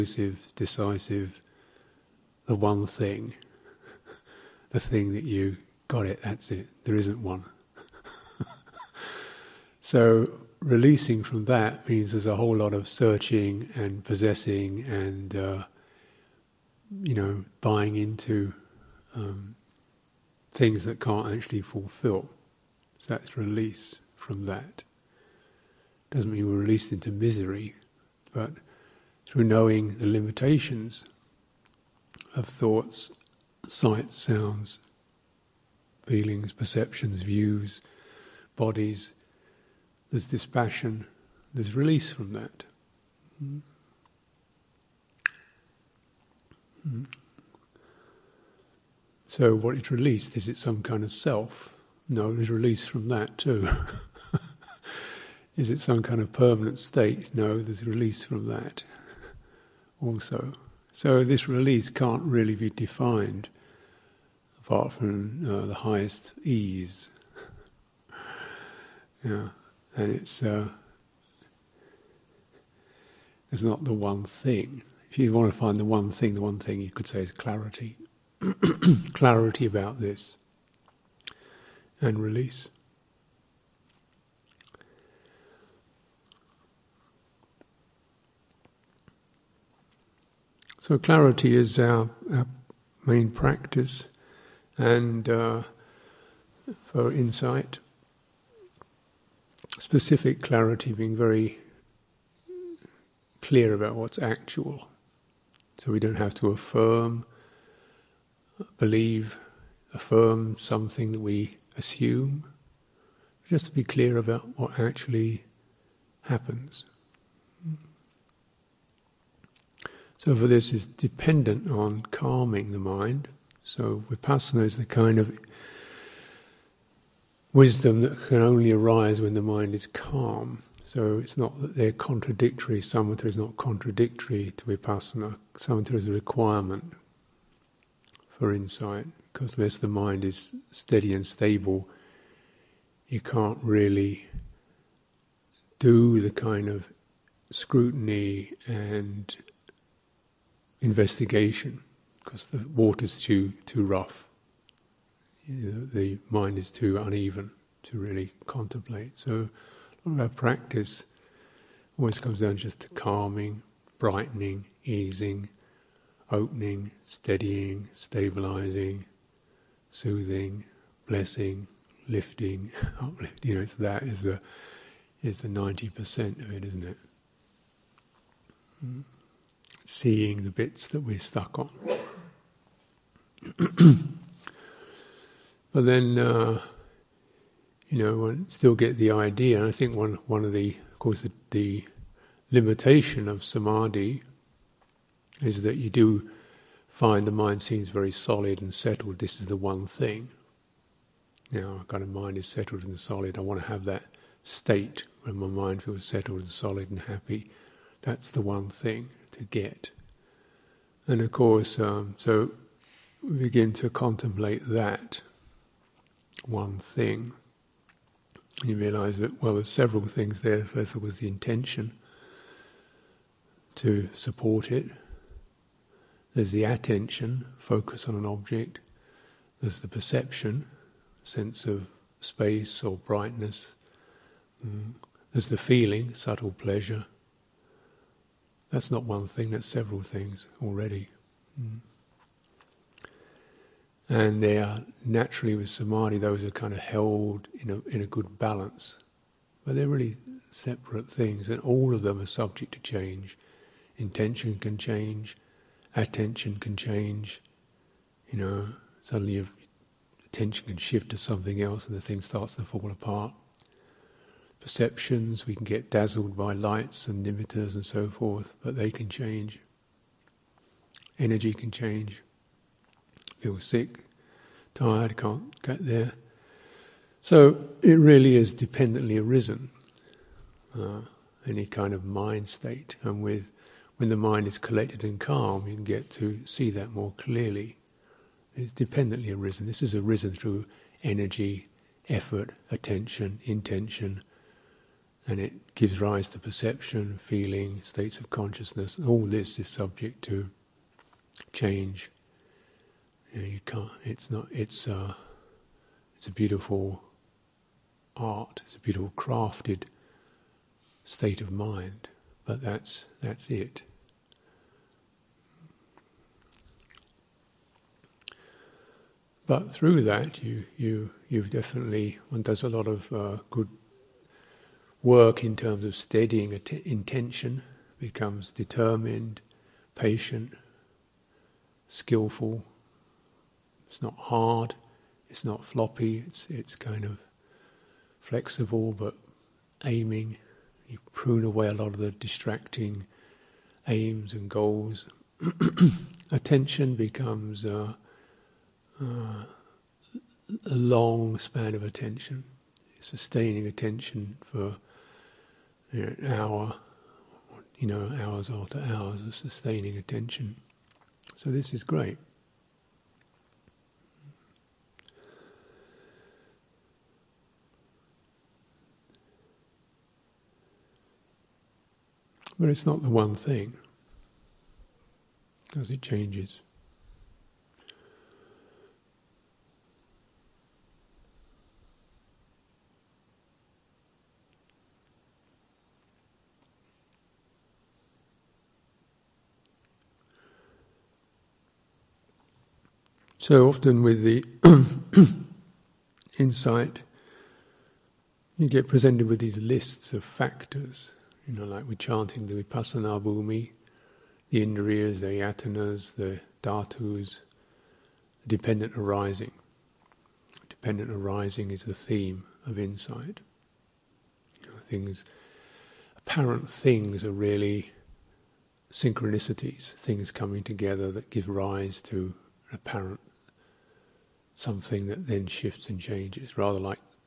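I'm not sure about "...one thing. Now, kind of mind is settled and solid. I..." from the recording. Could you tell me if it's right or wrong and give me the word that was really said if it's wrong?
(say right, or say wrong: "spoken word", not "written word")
right.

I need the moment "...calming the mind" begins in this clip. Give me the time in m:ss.
2:02.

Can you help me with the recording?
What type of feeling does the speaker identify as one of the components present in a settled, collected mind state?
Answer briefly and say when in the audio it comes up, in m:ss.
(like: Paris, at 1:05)
subtle pleasure, at 3:56.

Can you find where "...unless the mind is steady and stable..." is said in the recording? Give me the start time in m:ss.
2:19.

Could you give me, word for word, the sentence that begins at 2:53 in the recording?
You know, so that is the is the ninety percent of it, isn't it?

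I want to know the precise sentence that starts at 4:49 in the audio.
This is arisen through energy, effort, attention, intention, and it gives rise to perception, feeling, states of consciousness.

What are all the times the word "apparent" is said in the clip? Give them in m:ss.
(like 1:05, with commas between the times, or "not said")
6:56, 7:02.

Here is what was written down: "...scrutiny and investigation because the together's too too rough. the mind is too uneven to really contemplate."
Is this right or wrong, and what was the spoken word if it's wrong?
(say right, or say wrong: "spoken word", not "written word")
wrong: "water", not "together".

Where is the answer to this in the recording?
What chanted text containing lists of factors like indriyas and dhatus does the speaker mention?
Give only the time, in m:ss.
6:42.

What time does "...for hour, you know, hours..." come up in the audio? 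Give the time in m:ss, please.
5:54.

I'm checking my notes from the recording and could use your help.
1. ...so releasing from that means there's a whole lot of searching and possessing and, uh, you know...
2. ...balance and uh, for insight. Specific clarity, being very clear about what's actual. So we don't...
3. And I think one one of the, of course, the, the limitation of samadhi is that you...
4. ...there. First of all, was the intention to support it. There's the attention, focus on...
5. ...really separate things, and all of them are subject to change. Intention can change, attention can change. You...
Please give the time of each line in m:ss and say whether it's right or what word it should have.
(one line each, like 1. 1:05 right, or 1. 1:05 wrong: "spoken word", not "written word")
1. 0:09 right
2. 1:33 wrong: "practice", not "balance"
3. 3:09 right
4. 3:40 right
5. 4:09 right.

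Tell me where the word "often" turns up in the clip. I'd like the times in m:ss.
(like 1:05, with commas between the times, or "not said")
6:33.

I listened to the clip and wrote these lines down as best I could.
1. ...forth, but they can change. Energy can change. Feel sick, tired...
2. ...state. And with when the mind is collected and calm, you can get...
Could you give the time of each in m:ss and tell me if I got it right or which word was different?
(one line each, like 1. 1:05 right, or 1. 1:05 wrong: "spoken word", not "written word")
1. 4:28 right
2. 4:42 right.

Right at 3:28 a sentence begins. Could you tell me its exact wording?
That's the one thing to get.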